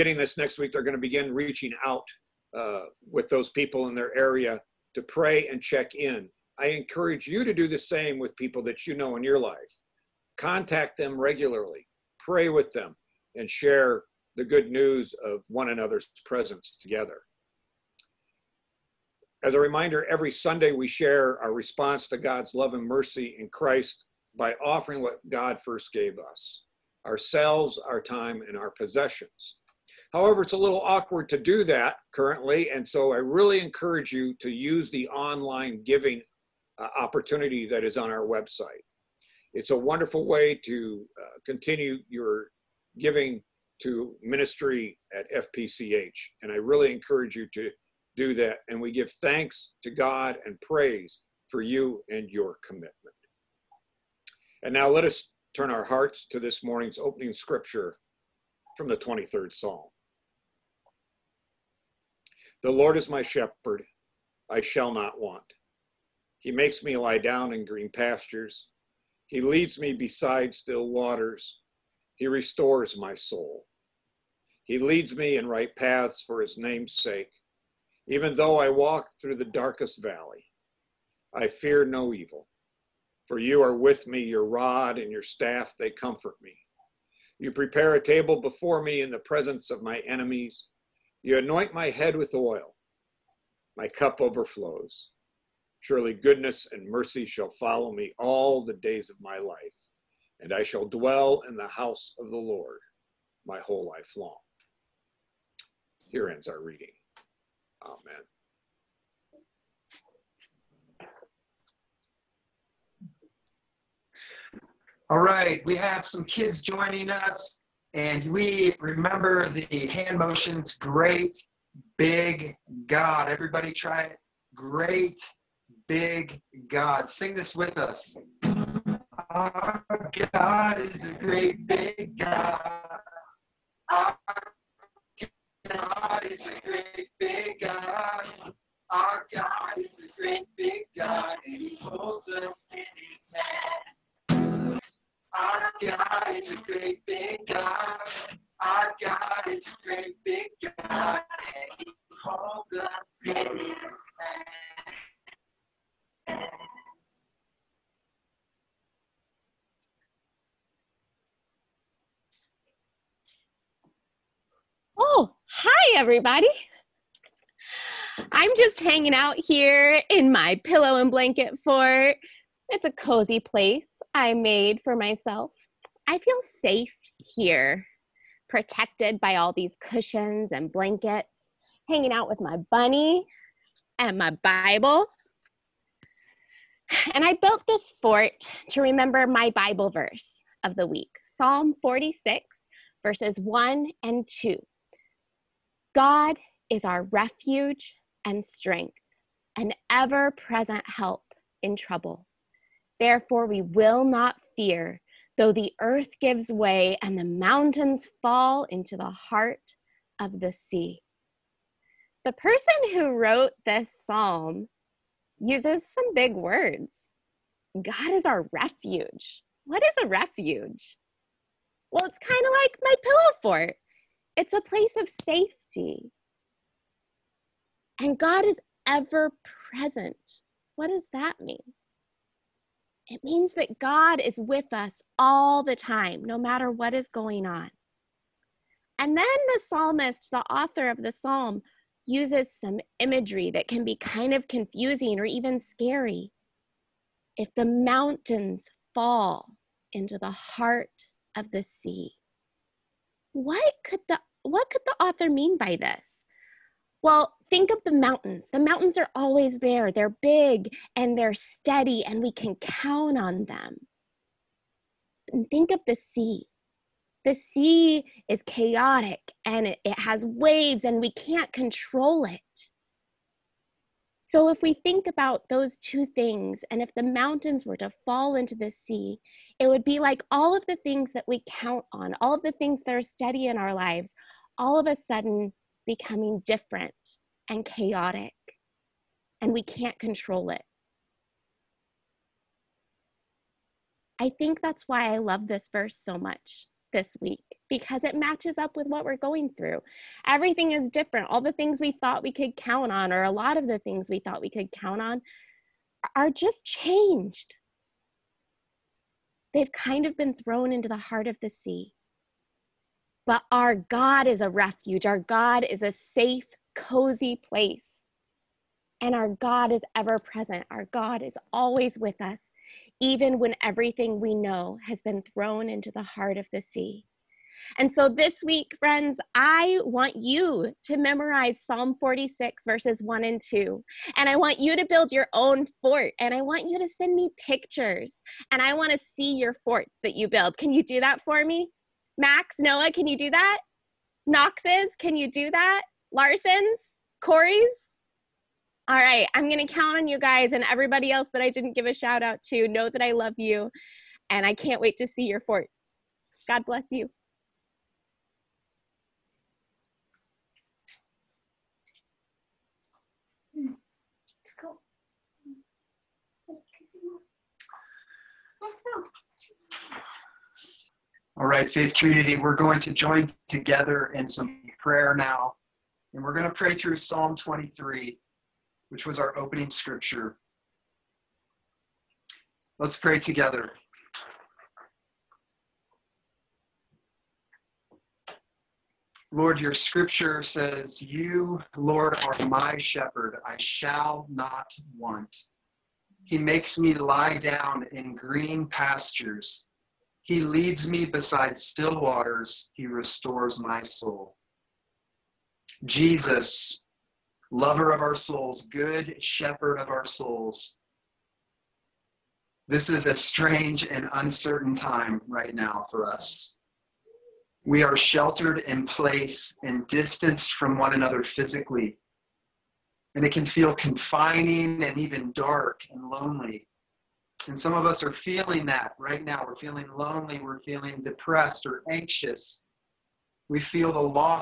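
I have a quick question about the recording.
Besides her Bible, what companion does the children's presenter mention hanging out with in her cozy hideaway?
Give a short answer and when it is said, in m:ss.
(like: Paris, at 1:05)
bunny, at 3:02.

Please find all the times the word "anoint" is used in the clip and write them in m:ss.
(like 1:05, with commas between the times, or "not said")
1:31.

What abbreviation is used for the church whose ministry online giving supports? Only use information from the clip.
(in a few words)
FPCH.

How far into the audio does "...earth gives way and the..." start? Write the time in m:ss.
3:25.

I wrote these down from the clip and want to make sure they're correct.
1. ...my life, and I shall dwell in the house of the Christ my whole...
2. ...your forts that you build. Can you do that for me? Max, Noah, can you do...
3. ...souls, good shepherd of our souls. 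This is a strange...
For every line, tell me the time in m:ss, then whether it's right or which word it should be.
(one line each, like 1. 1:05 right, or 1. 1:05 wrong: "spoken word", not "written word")
1. 1:39 wrong: "Lord", not "Christ"
2. 5:39 right
3. 6:48 right.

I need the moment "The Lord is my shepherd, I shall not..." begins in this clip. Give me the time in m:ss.
1:02.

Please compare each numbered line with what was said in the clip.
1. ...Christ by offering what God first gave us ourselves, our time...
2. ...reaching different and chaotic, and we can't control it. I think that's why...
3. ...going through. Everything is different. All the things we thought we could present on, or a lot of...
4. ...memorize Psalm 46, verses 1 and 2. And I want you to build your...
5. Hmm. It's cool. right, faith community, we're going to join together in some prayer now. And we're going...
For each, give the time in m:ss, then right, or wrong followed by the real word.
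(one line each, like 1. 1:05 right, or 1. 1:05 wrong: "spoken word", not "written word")
1. 0:23 right
2. 4:45 wrong: "becoming", not "reaching"
3. 4:59 wrong: "count", not "present"
4. 5:30 right
5. 6:03 right.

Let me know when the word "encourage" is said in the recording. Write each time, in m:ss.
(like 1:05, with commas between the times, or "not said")
0:06, 0:33, 0:46.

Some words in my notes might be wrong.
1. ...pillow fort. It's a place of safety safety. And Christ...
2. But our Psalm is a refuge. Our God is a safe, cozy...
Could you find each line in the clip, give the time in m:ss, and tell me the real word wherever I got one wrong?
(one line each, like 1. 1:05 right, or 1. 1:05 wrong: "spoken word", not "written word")
1. 3:43 wrong: "God", not "Christ"
2. 5:13 wrong: "God", not "Psalm".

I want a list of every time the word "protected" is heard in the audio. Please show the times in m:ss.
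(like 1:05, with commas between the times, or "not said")
2:58.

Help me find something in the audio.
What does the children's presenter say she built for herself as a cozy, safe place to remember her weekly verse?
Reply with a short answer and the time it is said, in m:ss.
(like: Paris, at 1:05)
pillow and blanket fort, at 2:50.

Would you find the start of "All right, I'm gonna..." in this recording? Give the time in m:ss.
5:48.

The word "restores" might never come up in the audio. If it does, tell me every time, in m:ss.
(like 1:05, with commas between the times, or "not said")
1:12, 6:42.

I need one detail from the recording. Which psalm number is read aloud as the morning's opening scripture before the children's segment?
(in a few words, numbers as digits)
23rd Psalm.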